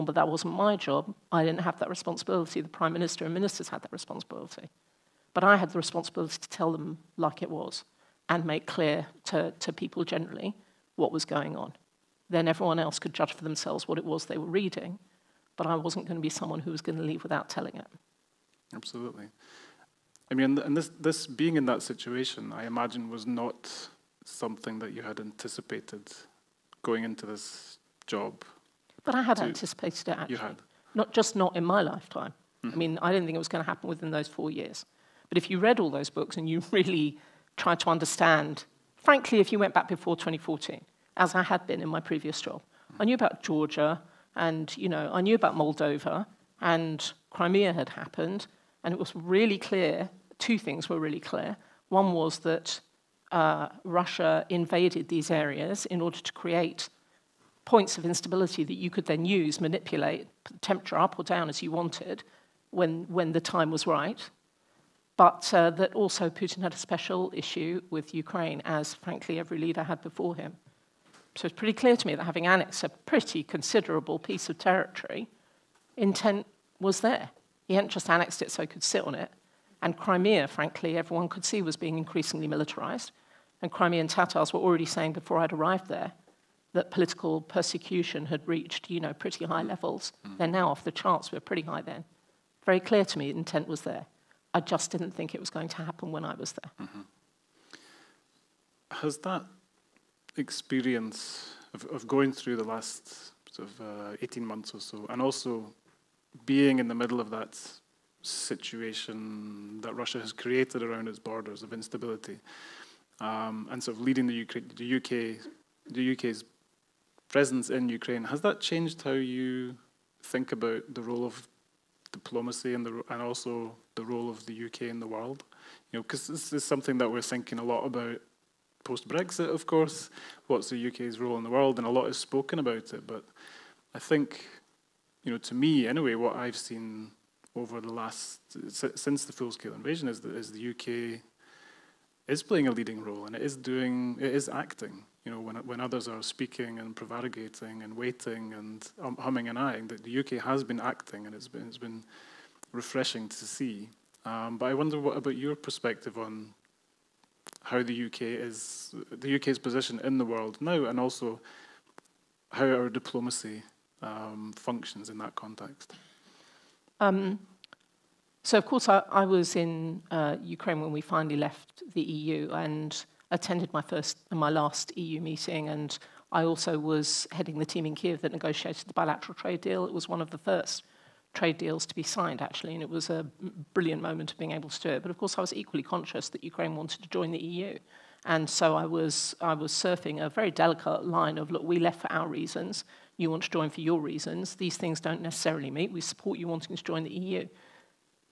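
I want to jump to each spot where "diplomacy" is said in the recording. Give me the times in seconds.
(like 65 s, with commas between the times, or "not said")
122 s, 162 s.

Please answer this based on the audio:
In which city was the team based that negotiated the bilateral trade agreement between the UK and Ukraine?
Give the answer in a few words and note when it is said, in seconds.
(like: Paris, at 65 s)
Kiev, at 177 s.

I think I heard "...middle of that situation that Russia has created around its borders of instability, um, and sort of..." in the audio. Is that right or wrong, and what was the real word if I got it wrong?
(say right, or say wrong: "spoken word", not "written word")
right.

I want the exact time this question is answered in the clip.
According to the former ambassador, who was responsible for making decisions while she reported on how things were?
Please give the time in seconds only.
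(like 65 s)
2 s.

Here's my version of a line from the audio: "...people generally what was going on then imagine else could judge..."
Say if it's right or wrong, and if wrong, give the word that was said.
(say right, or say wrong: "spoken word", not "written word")
wrong: "everyone", not "imagine".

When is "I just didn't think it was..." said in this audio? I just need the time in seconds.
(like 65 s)
94 s.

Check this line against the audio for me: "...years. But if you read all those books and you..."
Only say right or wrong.
right.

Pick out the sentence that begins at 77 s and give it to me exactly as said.
He hadn't just annexed it so he could sit on it.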